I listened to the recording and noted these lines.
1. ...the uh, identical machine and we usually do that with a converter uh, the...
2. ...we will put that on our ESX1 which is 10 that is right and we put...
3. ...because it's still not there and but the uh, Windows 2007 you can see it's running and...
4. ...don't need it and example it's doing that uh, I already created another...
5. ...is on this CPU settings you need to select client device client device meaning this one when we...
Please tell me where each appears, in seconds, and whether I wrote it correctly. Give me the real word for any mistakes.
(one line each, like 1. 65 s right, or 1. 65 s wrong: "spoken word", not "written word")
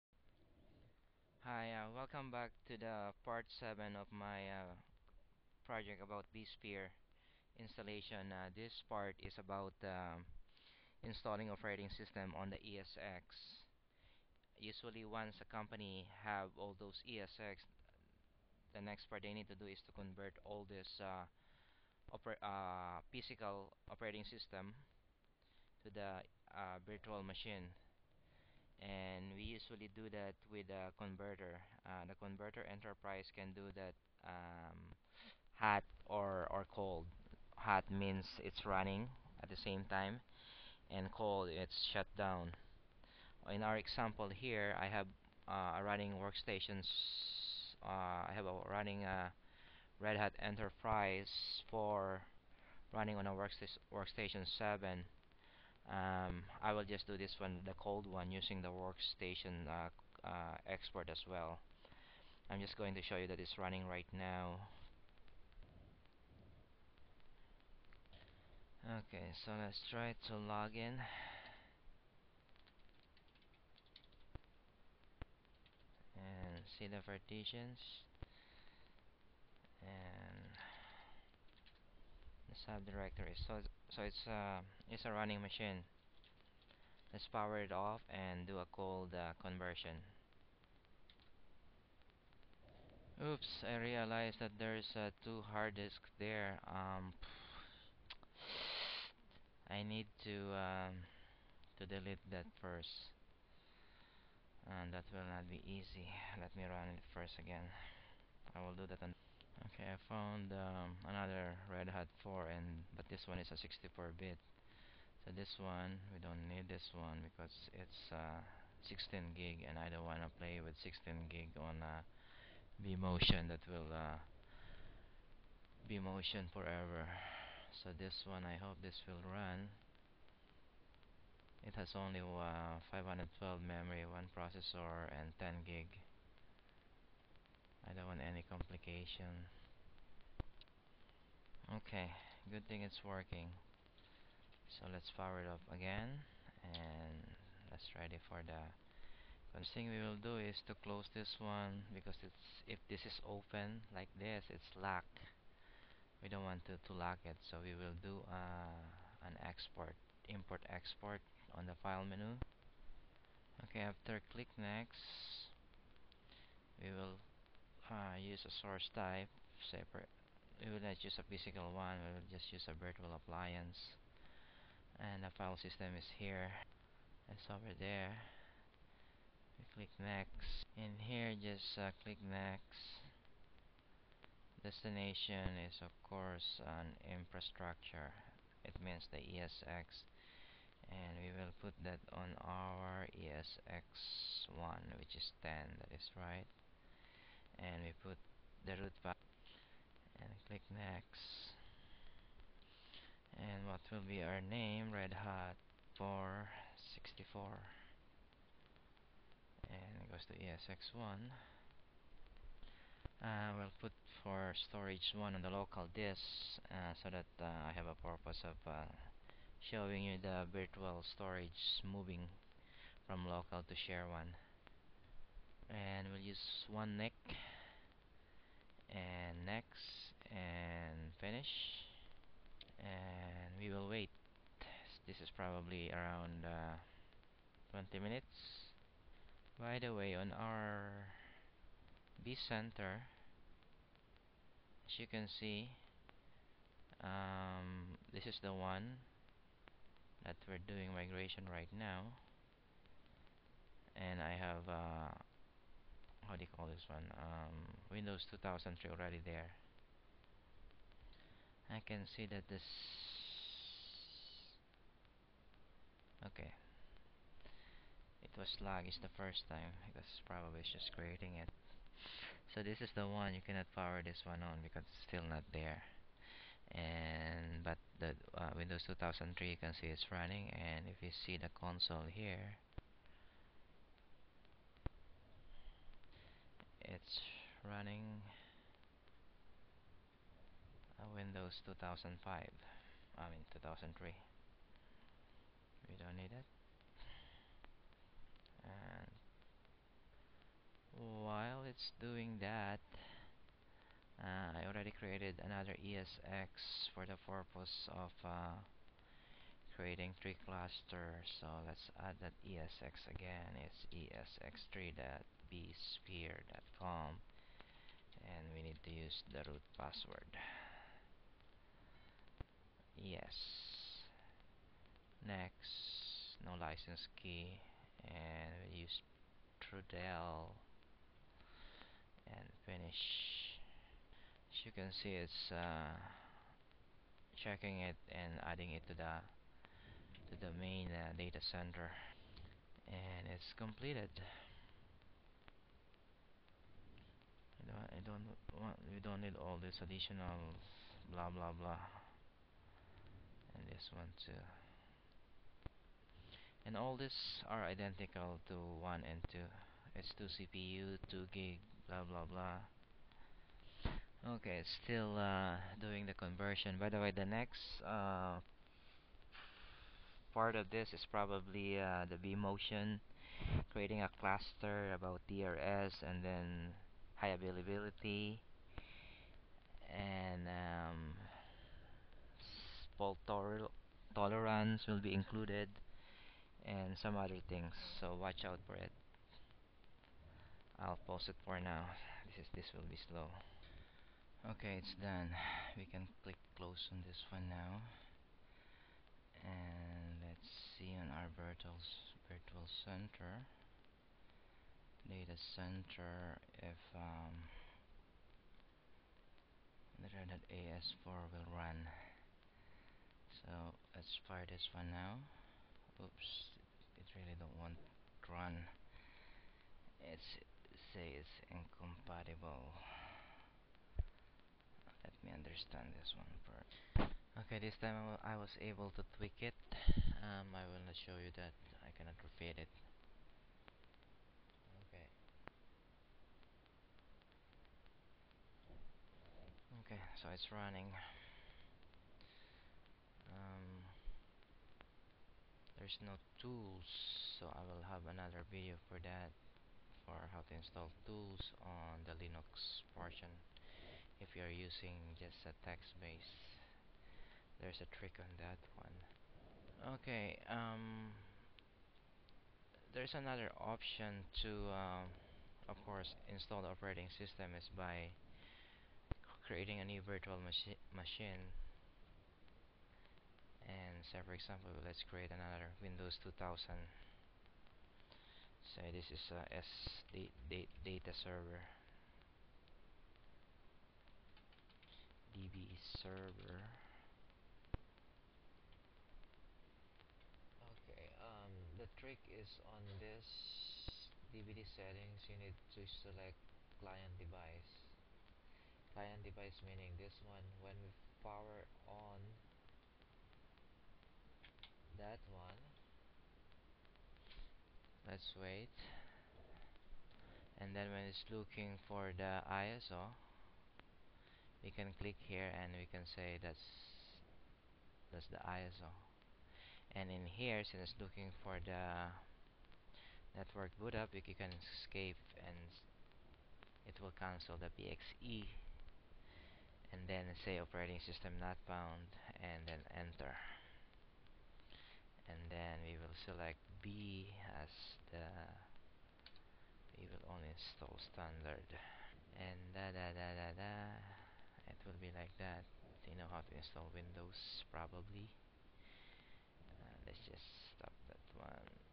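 1. 25 s wrong: "virtual", not "identical"
2. 191 s right
3. 274 s wrong: "2003", not "2007"
4. 295 s wrong: "while", not "example"
5. 492 s wrong: "DVD", not "CPU".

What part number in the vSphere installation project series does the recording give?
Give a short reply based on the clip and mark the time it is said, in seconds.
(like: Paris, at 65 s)
7, at 3 s.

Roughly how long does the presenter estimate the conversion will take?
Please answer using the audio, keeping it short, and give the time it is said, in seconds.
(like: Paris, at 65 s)
20 minutes, at 237 s.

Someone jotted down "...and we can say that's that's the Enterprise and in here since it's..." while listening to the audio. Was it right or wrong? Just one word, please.
wrong.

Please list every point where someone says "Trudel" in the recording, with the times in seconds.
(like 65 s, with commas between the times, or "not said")
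329 s.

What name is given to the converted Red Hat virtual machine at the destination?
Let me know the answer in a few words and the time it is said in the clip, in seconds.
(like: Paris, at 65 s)
Red Hat 464, at 204 s.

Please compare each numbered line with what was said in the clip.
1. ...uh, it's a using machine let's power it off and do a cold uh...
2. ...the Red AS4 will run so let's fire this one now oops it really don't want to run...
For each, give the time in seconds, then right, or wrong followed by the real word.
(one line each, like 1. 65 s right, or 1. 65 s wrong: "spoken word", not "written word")
1. 84 s wrong: "running", not "using"
2. 410 s right.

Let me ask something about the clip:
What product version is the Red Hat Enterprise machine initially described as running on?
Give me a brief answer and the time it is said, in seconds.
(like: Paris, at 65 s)
Workstation 7, at 53 s.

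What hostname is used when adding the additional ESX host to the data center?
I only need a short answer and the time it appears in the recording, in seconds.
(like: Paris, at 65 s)
esx3.vsphere.com, at 313 s.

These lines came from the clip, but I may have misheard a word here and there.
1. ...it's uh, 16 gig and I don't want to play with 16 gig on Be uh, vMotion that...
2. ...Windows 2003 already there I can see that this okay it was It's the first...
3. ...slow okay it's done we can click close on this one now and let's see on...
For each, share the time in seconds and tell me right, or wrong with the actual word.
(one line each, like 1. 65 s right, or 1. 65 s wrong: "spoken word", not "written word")
1. 117 s right
2. 257 s right
3. 393 s right.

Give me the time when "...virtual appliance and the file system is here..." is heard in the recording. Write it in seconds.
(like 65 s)
172 s.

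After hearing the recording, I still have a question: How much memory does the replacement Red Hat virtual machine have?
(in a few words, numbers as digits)
512.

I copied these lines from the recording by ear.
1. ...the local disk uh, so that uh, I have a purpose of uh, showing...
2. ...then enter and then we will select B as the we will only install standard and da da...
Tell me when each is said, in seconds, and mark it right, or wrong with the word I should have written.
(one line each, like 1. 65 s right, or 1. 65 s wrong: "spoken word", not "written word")
1. 215 s right
2. 532 s right.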